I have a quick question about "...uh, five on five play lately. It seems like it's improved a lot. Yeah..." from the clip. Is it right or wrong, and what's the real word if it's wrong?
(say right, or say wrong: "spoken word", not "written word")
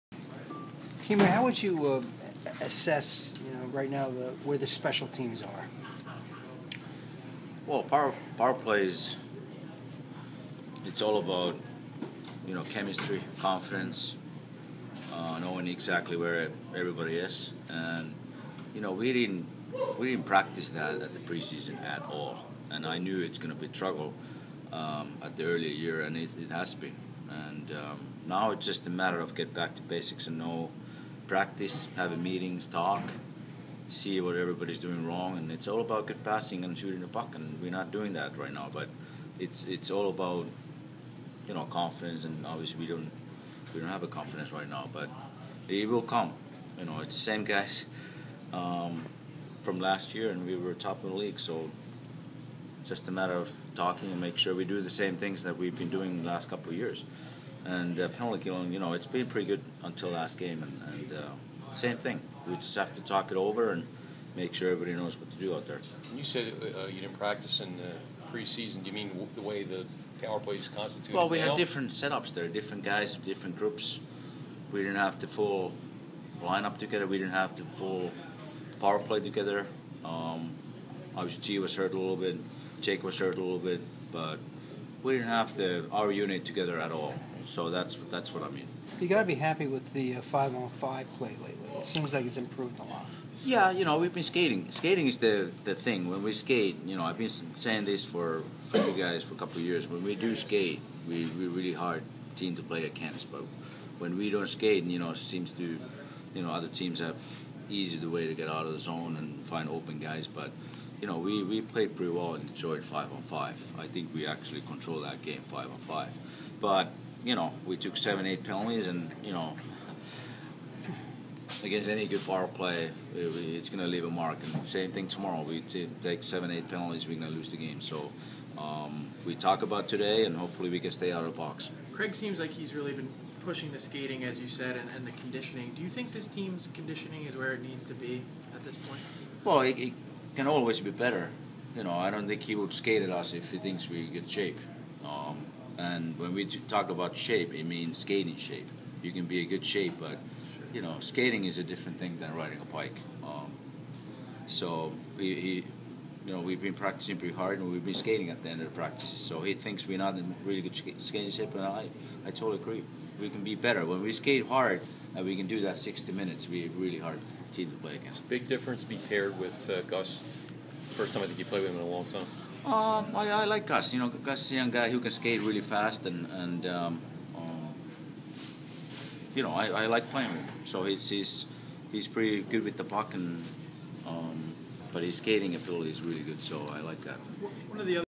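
right.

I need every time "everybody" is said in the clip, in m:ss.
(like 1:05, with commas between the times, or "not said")
0:16, 0:34, 1:04.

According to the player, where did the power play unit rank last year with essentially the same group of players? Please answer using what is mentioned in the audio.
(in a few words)
top of the league.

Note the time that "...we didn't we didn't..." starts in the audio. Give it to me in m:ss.
0:18.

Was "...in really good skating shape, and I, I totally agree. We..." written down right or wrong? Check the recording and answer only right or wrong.
right.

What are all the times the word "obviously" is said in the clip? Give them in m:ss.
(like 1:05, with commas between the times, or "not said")
0:42, 1:21.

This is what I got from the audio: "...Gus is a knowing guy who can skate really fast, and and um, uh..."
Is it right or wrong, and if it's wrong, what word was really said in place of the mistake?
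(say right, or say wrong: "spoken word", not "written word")
wrong: "young", not "knowing".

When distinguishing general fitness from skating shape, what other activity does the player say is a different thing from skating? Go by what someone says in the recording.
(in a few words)
riding a bike.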